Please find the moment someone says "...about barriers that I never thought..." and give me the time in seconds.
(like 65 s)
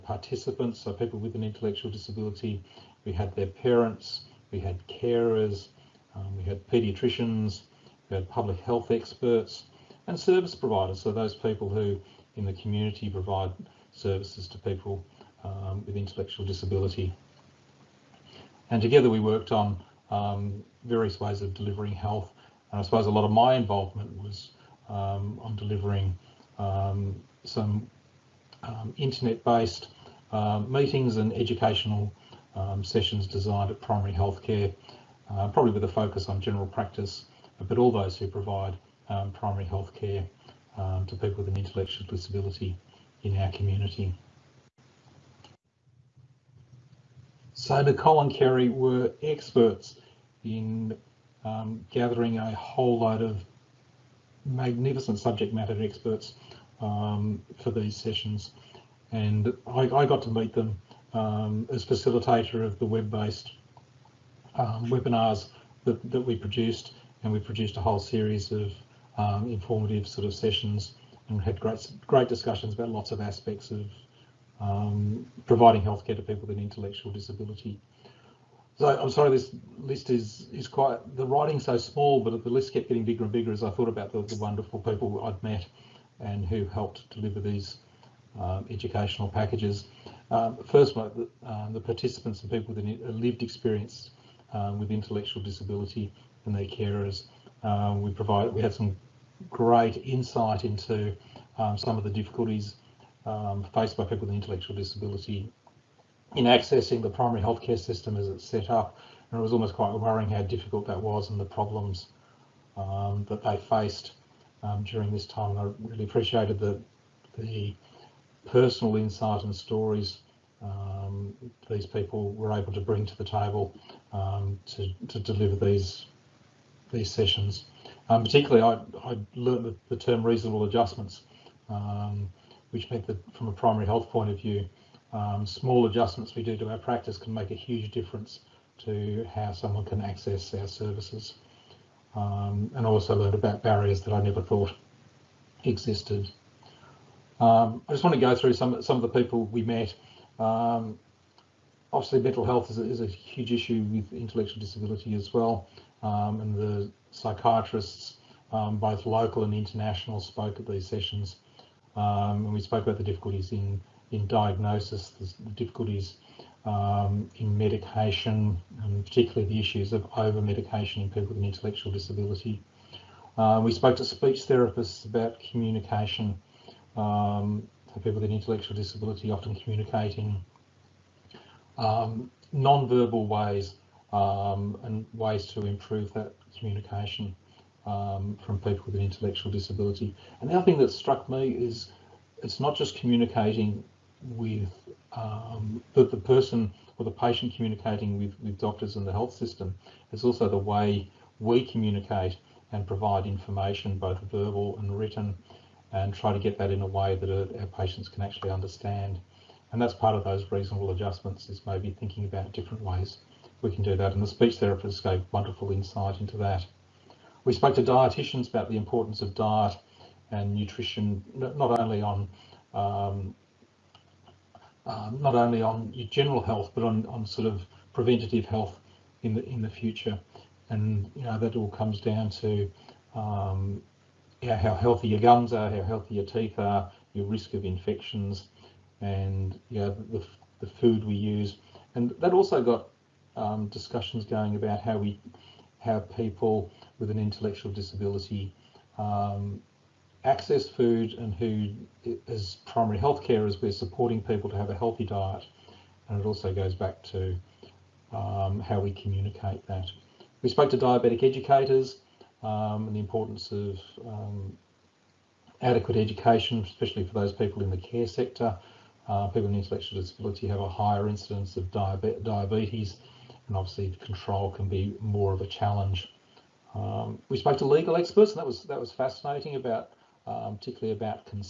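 143 s.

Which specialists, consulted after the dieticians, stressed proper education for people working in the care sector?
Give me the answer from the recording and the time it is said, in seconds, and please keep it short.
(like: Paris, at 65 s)
diabetic educators, at 260 s.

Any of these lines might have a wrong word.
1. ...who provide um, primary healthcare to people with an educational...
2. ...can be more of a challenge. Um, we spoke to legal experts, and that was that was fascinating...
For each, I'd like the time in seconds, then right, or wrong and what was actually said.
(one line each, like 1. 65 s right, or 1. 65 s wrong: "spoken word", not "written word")
1. 38 s wrong: "intellectual", not "educational"
2. 274 s right.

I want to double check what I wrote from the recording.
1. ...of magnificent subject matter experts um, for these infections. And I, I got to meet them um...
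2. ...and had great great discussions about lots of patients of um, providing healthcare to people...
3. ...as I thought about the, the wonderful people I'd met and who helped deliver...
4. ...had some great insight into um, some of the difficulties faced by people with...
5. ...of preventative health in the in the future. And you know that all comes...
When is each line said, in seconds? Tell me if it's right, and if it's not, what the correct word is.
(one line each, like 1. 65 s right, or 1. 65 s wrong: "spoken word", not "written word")
1. 53 s wrong: "sessions", not "infections"
2. 71 s wrong: "aspects", not "patients"
3. 83 s right
4. 98 s right
5. 227 s right.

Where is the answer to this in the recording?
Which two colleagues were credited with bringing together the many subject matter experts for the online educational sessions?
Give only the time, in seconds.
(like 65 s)
47 s.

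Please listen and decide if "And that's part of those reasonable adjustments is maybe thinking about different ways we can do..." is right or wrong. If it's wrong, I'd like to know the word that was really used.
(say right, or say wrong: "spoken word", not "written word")
right.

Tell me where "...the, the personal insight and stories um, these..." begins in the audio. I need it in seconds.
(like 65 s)
116 s.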